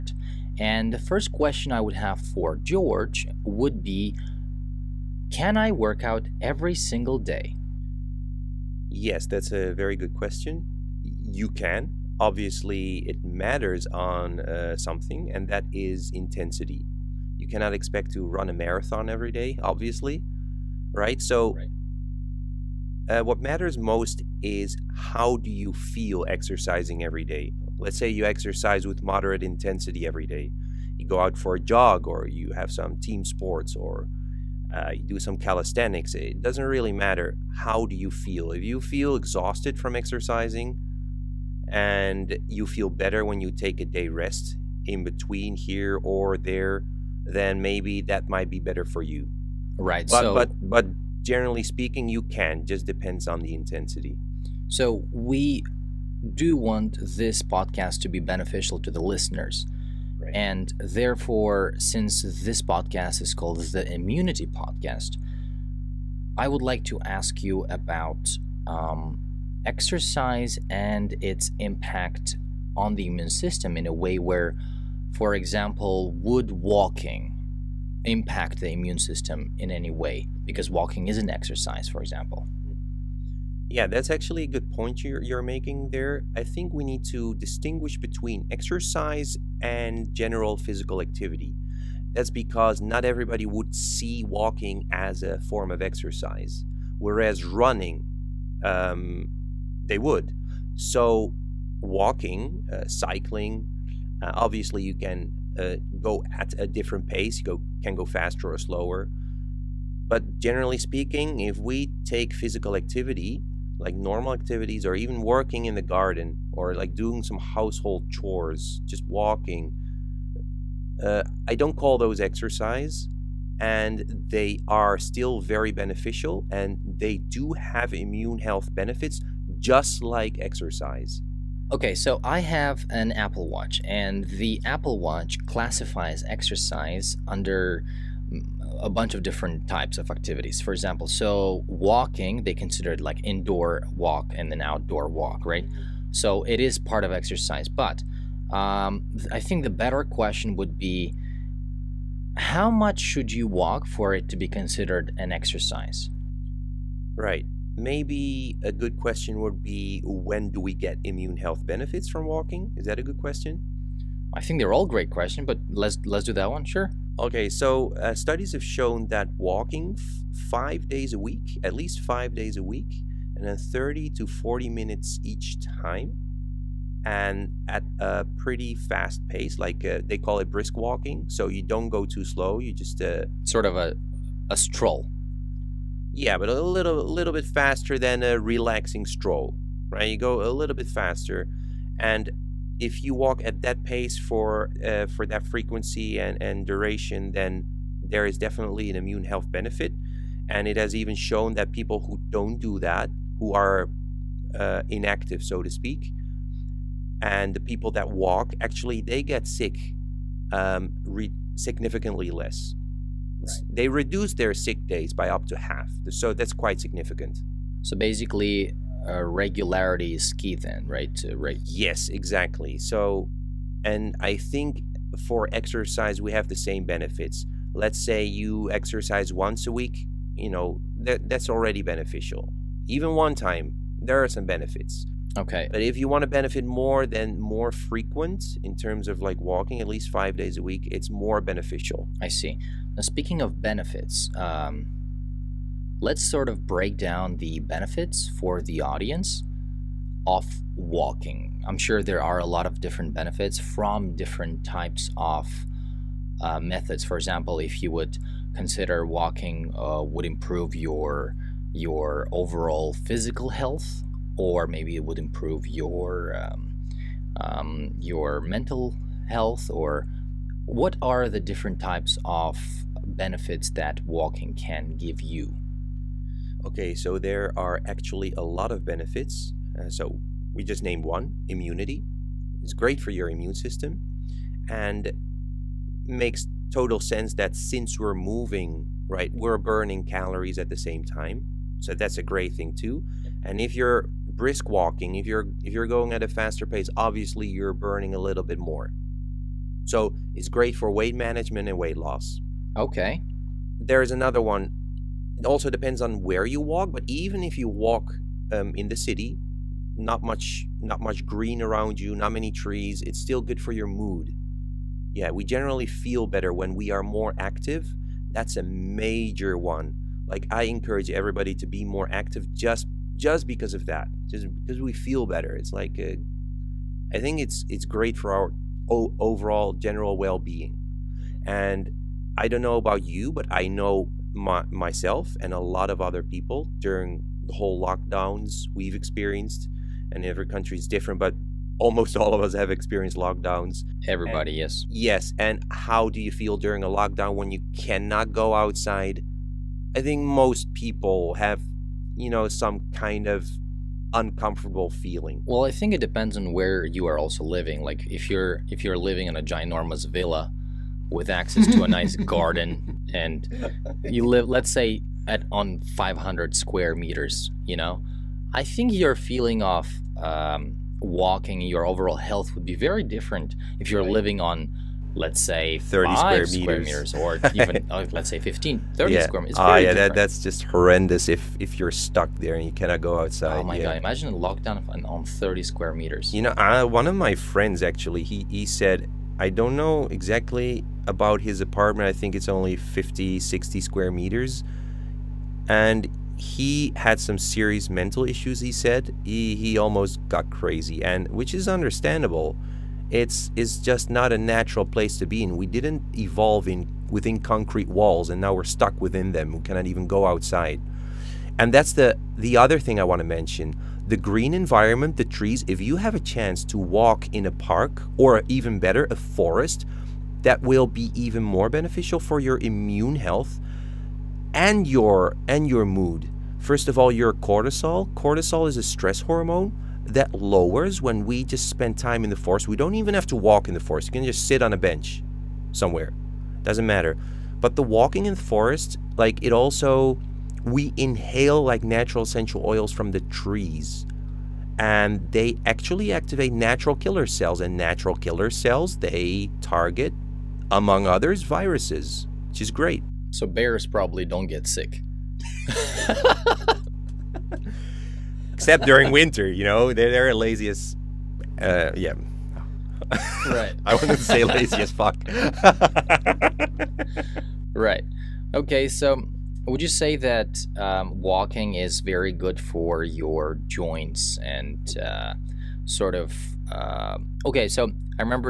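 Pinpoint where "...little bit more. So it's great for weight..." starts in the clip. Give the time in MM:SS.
04:58.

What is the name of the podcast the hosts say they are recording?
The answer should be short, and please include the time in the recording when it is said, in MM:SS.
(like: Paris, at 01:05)
The Immunity Podcast, at 01:03.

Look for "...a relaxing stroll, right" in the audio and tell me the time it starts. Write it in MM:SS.
03:08.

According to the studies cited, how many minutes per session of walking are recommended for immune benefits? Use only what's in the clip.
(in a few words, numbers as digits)
30 to 40 minutes.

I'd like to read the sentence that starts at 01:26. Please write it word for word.
I think we need to distinguish between exercise and general physical activity.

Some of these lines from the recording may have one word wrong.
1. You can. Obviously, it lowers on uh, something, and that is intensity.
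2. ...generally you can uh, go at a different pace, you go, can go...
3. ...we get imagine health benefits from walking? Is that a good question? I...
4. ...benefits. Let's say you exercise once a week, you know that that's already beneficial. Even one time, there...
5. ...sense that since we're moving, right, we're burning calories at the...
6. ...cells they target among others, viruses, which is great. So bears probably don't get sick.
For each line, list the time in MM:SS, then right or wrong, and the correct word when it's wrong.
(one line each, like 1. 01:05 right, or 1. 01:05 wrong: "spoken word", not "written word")
1. 00:11 wrong: "matters", not "lowers"
2. 01:44 wrong: "obviously", not "generally"
3. 02:40 wrong: "immune", not "imagine"
4. 03:46 right
5. 04:46 right
6. 07:28 right.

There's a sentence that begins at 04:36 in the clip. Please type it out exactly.
Okay, so there are actually a lot of benefits.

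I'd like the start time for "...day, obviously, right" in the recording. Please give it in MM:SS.
00:19.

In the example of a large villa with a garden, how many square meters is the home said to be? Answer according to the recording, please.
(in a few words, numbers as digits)
500 square meters.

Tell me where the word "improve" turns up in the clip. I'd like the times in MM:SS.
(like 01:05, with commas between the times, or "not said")
04:20, 04:25.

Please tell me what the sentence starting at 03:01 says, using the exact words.
So you don't go too slow.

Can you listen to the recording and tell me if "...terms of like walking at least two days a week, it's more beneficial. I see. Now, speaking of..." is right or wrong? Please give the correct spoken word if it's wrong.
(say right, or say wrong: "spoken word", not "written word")
wrong: "five", not "two".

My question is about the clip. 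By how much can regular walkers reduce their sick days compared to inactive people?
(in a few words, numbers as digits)
up to half.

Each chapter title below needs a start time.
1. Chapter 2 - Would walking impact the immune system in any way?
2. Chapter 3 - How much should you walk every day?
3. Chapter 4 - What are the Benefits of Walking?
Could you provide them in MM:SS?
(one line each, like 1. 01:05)
1. 01:05
2. 02:11
3. 04:05.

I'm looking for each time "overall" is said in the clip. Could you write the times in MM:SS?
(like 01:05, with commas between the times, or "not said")
04:22, 05:28, 06:11.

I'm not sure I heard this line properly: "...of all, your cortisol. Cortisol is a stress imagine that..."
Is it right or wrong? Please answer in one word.
wrong.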